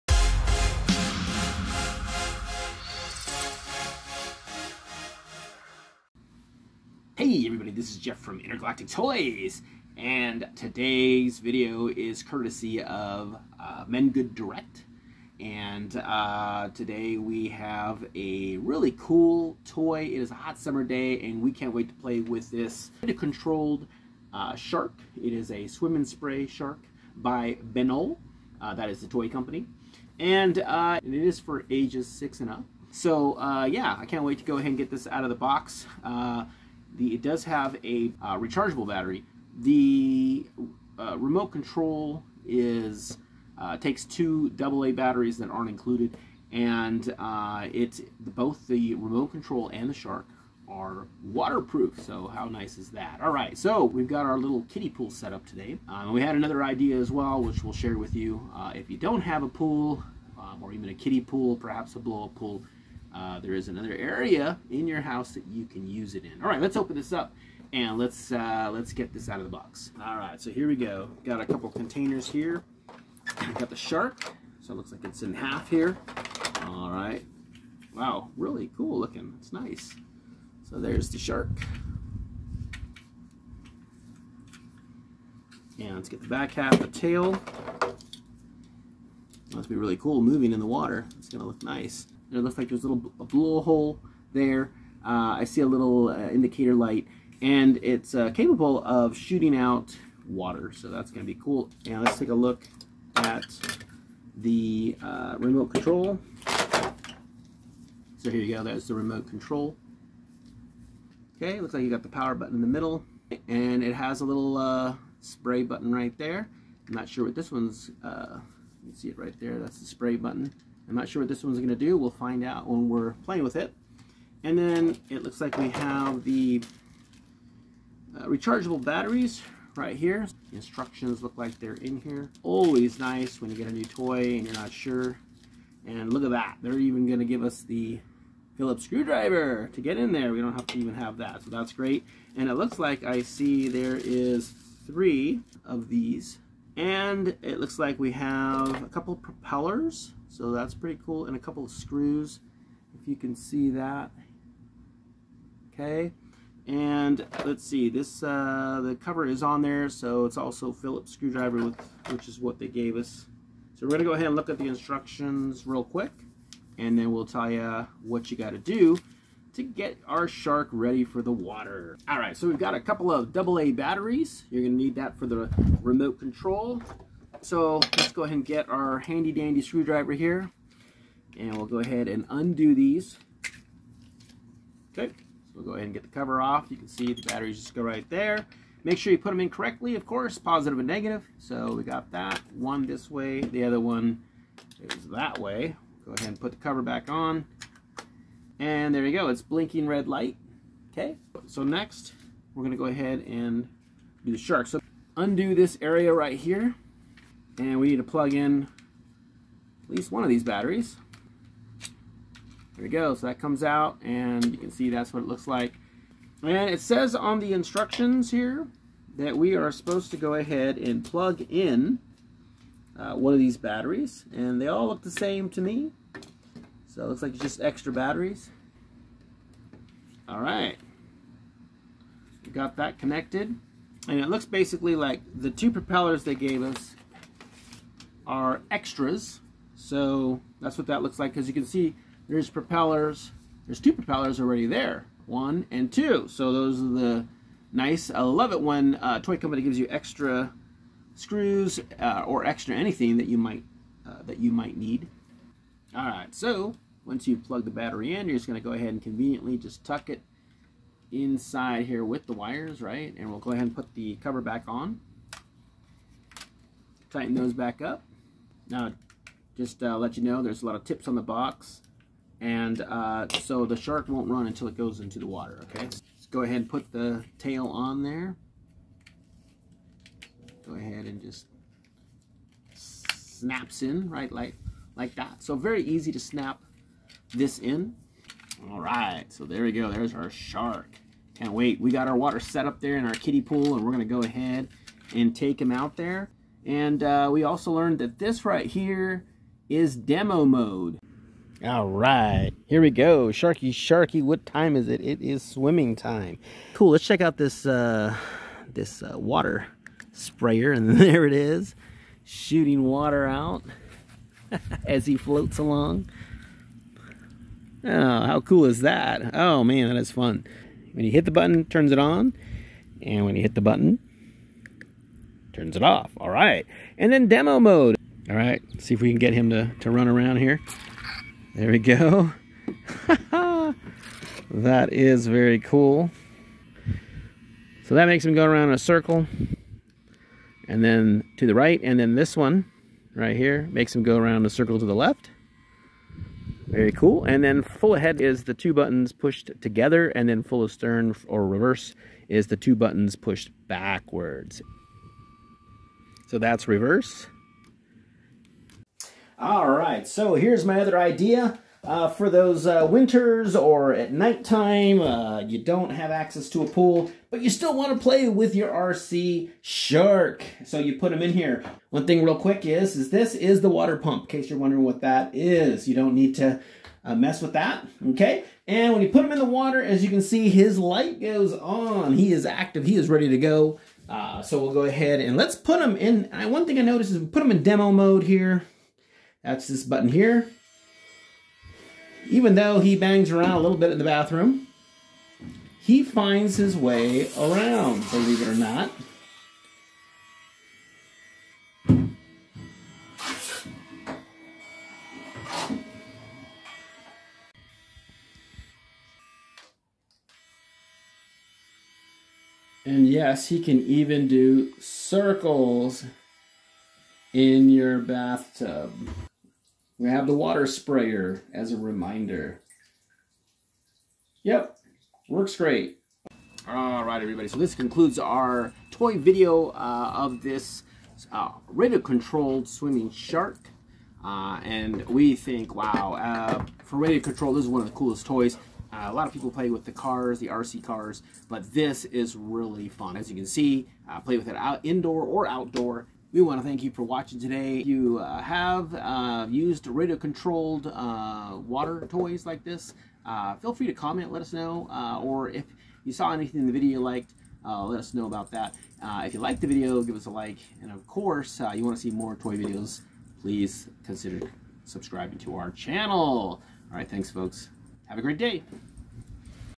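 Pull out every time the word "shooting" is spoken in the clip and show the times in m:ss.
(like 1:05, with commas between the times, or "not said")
1:39, 5:12.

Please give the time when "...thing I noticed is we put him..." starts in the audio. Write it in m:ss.
6:26.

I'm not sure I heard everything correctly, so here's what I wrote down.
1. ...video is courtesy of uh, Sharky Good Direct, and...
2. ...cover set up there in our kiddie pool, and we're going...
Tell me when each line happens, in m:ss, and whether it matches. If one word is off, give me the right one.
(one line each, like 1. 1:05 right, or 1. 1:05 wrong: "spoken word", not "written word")
1. 0:11 wrong: "Men", not "Sharky"
2. 4:52 wrong: "water", not "cover".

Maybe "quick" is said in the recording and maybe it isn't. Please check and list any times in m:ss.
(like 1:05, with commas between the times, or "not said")
2:45, 6:12.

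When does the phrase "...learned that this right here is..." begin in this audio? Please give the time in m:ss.
4:57.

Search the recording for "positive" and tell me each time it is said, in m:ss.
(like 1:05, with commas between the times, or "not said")
3:10.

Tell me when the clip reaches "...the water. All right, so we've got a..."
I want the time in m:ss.
2:51.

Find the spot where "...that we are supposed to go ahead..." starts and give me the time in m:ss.
3:39.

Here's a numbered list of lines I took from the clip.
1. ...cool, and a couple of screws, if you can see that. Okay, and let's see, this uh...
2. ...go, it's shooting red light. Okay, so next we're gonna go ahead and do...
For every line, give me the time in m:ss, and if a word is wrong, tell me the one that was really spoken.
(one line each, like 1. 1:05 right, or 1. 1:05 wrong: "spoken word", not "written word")
1. 2:31 right
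2. 3:19 wrong: "blinking", not "shooting".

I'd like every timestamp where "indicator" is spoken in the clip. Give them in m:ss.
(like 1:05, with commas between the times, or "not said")
1:36.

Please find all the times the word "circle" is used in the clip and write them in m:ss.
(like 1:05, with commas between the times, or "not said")
5:38, 5:44, 6:54.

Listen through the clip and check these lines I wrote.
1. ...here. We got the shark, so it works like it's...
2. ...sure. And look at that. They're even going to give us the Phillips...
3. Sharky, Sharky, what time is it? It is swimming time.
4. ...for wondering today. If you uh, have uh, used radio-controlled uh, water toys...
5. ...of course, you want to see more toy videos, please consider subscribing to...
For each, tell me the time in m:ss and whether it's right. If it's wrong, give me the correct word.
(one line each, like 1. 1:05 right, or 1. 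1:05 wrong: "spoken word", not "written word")
1. 1:12 wrong: "looks", not "works"
2. 2:14 right
3. 5:03 right
4. 7:26 wrong: "watching", not "wondering"
5. 7:40 right.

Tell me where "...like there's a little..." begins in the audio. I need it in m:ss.
1:32.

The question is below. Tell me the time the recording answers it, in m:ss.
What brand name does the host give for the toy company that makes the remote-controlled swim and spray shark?
0:27.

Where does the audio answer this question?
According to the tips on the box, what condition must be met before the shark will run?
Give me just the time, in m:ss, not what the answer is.
4:34.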